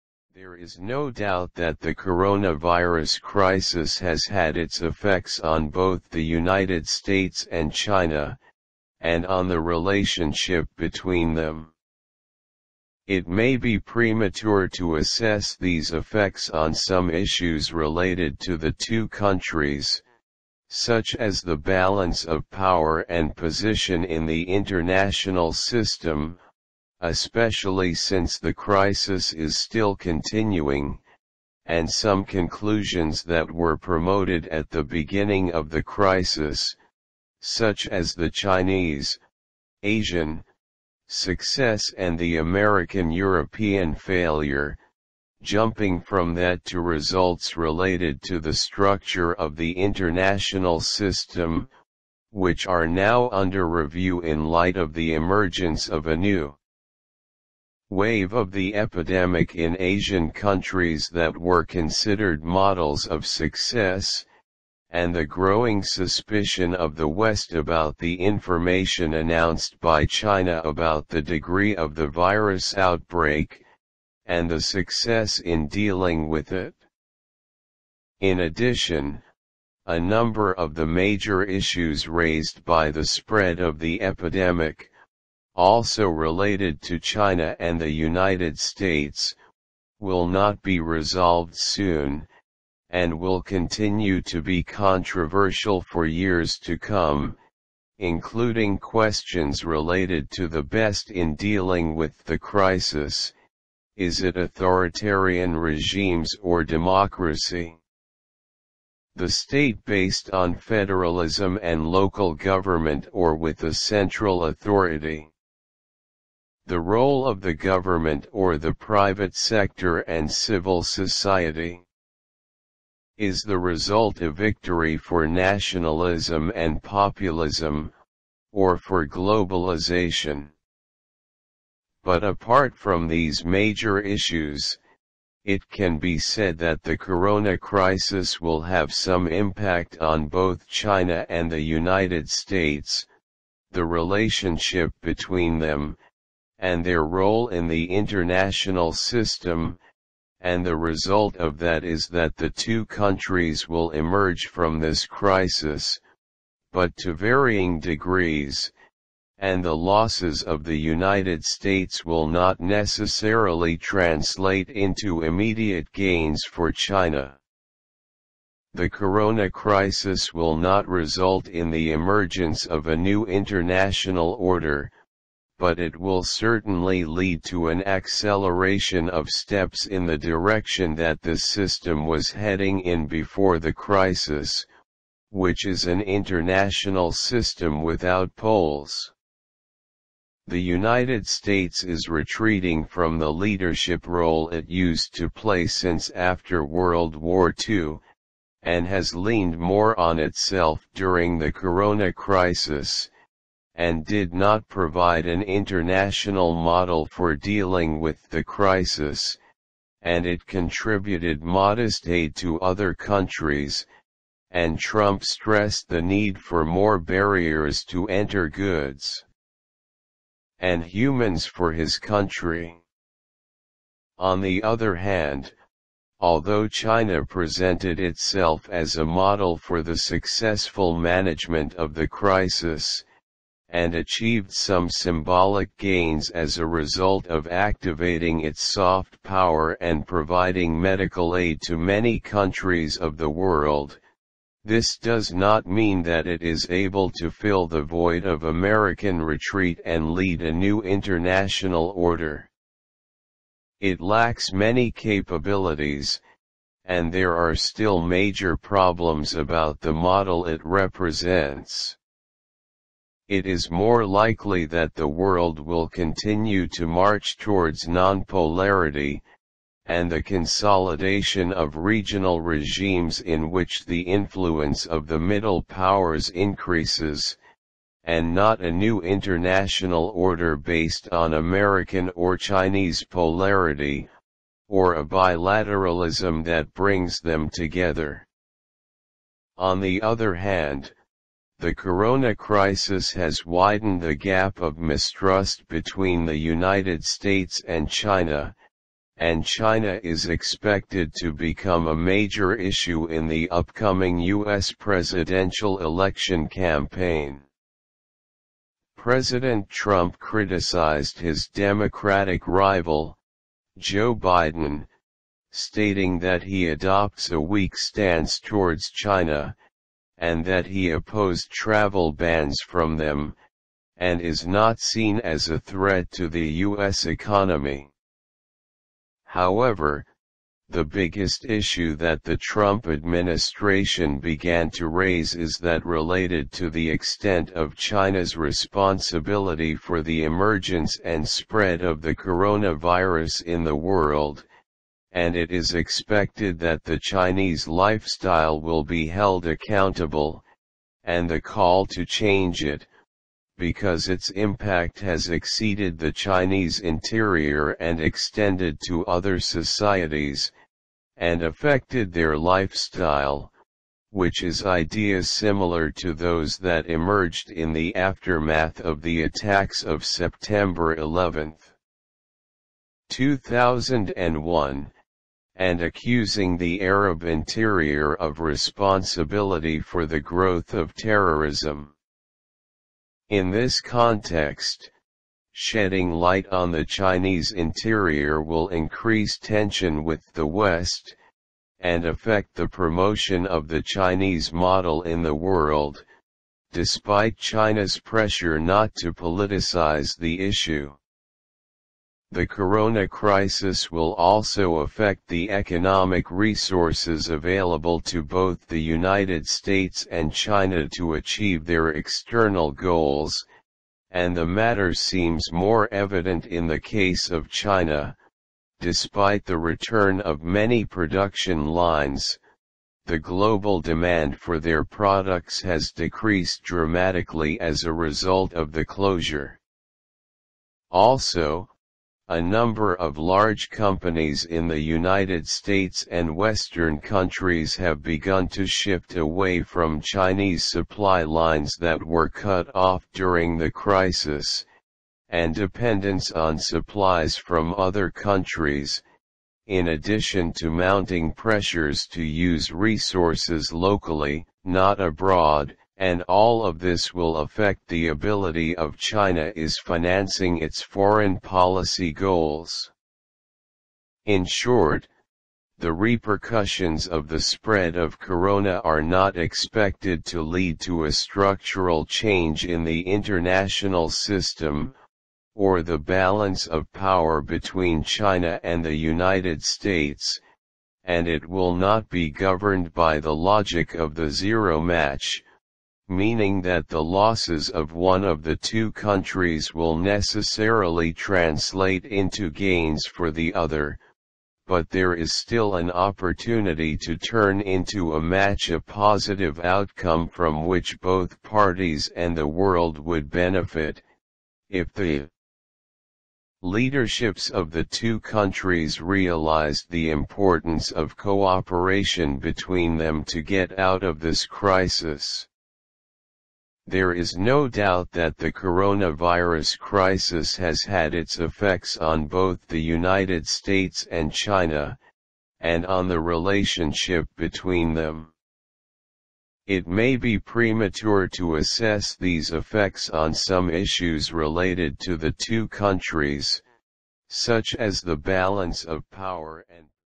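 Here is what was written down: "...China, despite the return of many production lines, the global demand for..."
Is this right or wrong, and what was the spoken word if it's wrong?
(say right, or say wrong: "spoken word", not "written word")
right.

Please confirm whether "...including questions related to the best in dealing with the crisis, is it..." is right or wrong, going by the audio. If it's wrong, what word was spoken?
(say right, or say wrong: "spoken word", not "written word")
right.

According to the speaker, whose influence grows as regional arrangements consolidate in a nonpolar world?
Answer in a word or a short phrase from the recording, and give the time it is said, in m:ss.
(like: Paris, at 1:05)
The middle powers, at 4:35.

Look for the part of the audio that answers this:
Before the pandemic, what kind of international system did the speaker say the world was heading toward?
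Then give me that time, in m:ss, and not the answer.
3:07.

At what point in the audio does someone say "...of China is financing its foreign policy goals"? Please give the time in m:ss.
7:38.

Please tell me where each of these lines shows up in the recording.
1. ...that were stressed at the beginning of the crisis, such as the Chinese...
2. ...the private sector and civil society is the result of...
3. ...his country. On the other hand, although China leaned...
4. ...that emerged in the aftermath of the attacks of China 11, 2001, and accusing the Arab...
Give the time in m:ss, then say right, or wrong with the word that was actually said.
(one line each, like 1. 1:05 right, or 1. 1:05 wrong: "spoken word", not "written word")
1. 0:33 wrong: "promoted", not "stressed"
2. 1:58 right
3. 3:41 wrong: "presented", not "leaned"
4. 6:06 wrong: "September", not "China".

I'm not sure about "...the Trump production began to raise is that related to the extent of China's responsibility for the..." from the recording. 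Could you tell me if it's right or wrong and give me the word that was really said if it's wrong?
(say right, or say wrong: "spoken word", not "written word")
wrong: "administration", not "production".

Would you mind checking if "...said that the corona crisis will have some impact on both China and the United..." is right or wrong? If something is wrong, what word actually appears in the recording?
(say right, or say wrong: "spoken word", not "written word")
right.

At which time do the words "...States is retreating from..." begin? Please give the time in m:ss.
3:11.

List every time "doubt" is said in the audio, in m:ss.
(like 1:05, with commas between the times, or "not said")
0:01, 8:37.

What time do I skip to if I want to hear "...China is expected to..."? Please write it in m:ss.
4:59.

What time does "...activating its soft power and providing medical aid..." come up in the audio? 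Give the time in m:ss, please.
3:57.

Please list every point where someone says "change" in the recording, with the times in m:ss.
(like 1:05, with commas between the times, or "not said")
5:52, 7:52.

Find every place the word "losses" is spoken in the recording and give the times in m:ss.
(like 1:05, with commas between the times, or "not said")
2:39, 8:07.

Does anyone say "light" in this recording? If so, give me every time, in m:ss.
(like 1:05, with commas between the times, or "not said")
0:54, 6:26.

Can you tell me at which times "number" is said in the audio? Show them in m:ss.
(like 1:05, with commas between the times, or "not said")
1:19, 7:12.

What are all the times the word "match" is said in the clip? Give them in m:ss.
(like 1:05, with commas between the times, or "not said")
8:04, 8:18.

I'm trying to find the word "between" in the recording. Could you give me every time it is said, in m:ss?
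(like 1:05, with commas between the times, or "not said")
0:10, 2:25, 4:55, 7:57, 8:32, 8:47.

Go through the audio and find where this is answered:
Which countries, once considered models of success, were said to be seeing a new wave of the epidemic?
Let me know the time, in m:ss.
0:59.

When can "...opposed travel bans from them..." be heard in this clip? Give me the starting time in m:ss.
5:20.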